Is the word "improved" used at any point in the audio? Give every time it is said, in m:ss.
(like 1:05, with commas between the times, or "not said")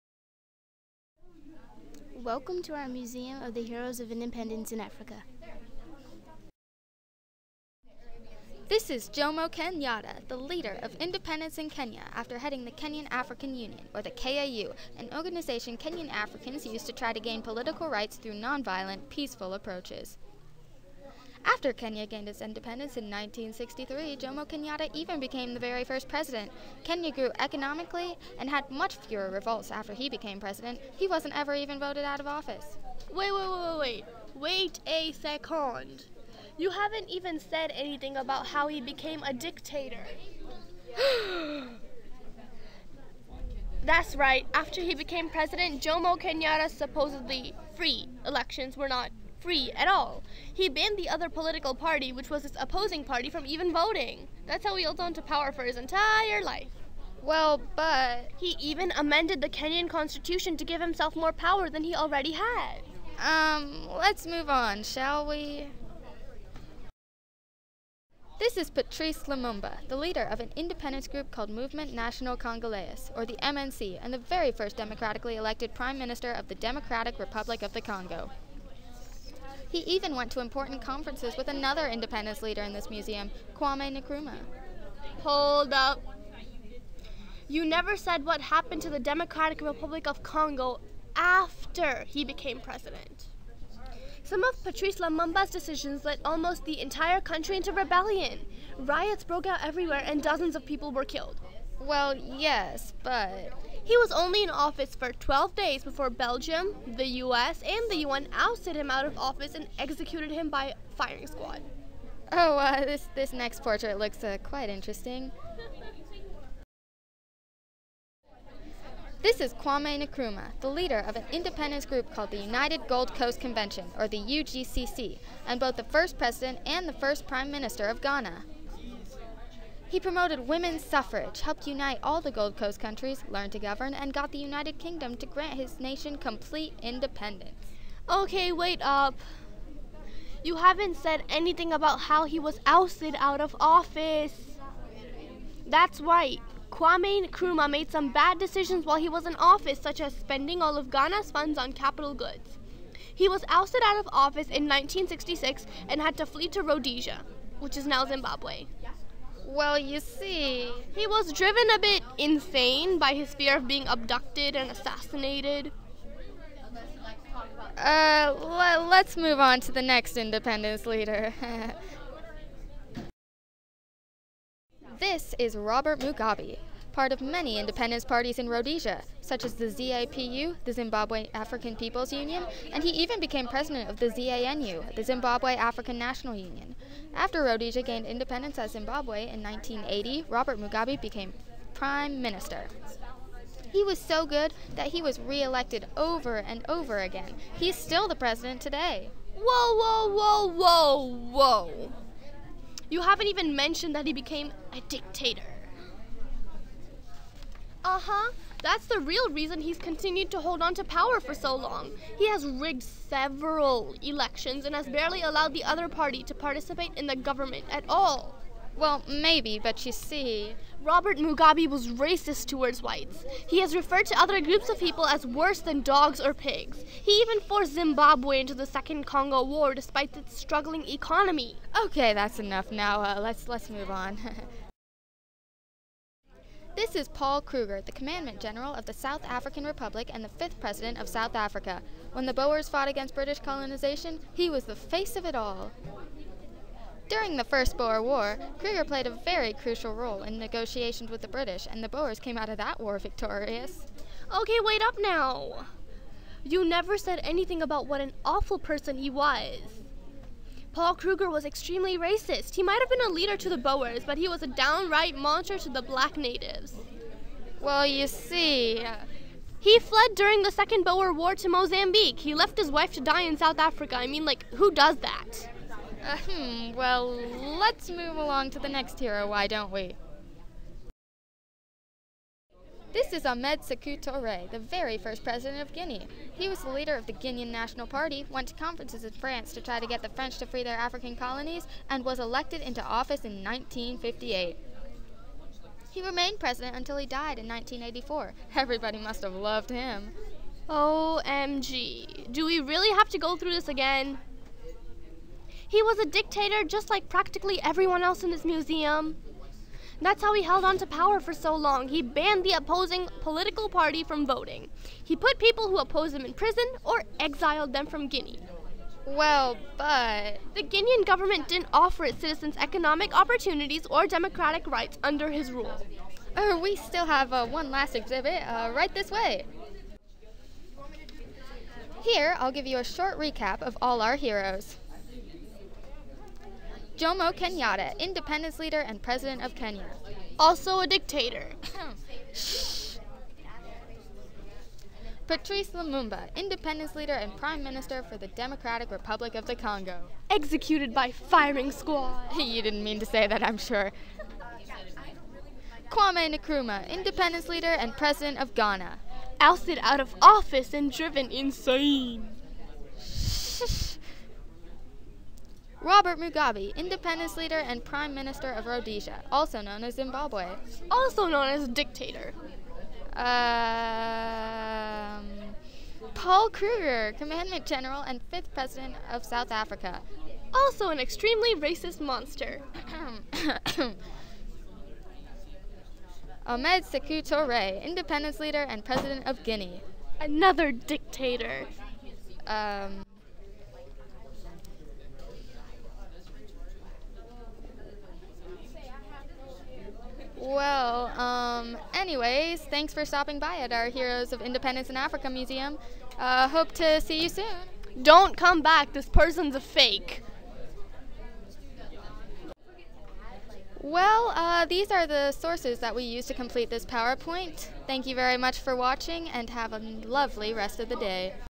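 not said.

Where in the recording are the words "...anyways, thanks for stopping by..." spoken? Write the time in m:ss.
6:42.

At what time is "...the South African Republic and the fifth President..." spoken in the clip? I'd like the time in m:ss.
3:58.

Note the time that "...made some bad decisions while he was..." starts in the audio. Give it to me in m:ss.
2:27.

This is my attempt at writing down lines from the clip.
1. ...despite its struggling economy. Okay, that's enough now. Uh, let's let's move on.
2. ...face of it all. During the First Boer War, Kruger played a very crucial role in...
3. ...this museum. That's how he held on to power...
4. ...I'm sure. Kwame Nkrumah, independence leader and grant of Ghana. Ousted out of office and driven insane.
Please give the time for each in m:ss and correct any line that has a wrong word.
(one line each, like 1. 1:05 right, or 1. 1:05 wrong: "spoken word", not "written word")
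1. 3:49 right
2. 4:04 right
3. 5:08 right
4. 5:53 wrong: "president", not "grant".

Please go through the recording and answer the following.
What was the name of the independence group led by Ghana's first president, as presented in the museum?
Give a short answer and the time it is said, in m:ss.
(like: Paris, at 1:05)
United Gold Coast Convention, at 2:02.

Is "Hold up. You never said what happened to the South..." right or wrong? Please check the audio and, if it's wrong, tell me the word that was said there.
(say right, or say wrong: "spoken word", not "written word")
wrong: "Democratic", not "South".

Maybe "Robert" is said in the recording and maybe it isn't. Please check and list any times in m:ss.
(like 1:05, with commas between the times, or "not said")
2:55, 3:10, 3:40, 6:05.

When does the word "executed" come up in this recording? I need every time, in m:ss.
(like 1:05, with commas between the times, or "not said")
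1:49, 5:50.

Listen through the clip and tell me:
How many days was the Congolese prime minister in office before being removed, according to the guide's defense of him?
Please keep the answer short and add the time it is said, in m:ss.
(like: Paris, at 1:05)
12, at 1:45.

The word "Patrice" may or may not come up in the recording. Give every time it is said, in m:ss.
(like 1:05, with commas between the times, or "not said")
1:08, 1:34, 5:45.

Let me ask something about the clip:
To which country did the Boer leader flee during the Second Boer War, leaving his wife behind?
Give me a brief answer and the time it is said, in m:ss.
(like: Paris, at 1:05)
Mozambique, at 4:31.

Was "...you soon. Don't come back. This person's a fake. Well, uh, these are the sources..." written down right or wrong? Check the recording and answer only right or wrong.
right.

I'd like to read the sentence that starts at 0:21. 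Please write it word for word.
After Kenya gained its independence in 1963, Jomo Kenyatta even became the very first president.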